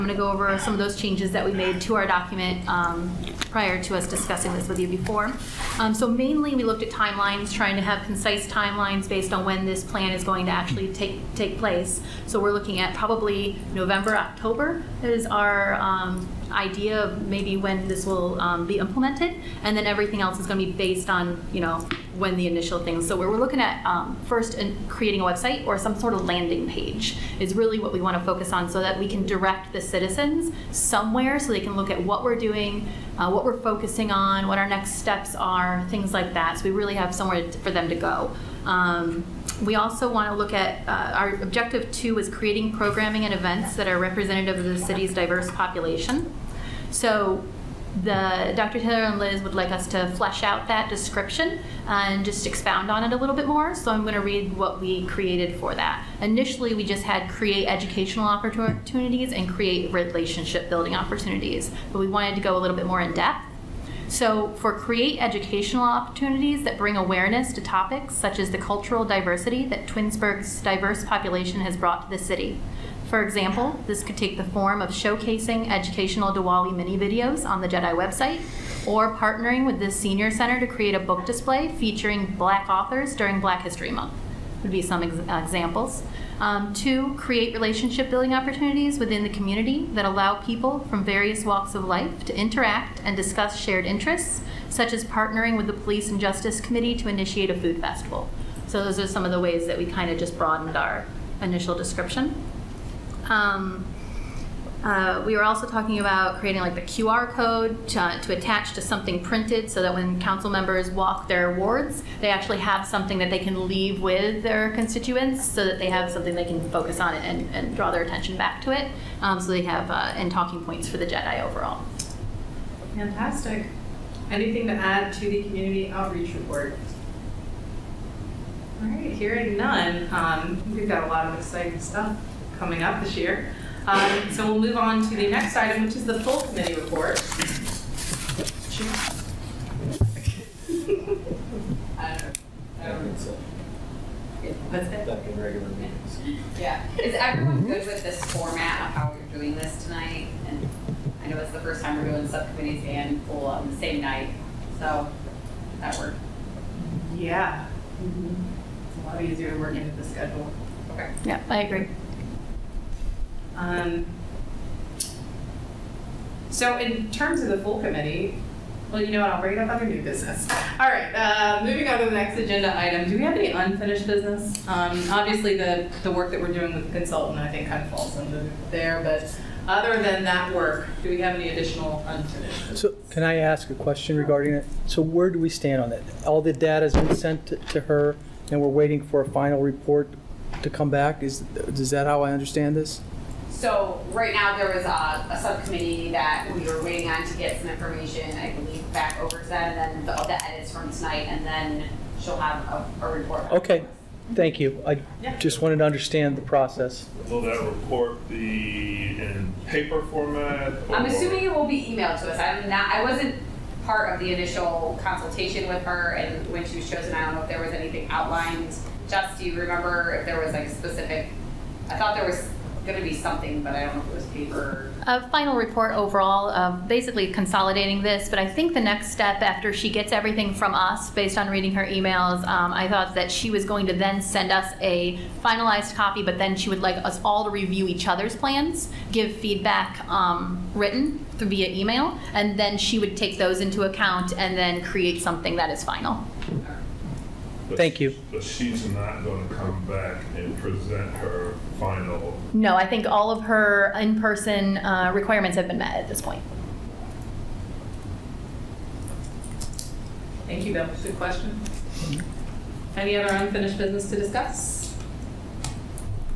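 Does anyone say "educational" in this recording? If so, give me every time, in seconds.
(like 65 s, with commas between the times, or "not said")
57 s, 65 s, 75 s.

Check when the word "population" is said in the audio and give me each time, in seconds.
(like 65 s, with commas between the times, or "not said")
45 s, 71 s.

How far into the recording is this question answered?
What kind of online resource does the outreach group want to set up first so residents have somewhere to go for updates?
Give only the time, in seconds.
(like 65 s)
26 s.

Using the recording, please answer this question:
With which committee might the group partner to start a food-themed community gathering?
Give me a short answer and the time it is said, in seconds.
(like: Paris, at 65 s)
Police and Justice Committee, at 95 s.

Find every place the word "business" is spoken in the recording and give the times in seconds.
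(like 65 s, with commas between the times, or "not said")
170 s, 174 s, 182 s, 263 s.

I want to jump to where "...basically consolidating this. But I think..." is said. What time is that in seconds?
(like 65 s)
226 s.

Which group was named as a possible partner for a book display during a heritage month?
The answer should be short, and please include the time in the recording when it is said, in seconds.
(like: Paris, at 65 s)
Senior Center, at 79 s.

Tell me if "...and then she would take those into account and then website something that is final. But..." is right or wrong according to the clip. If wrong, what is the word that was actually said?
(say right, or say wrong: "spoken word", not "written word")
wrong: "create", not "website".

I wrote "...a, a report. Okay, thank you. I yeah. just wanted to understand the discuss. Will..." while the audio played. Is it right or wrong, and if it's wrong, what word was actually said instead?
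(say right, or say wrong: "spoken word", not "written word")
wrong: "process", not "discuss".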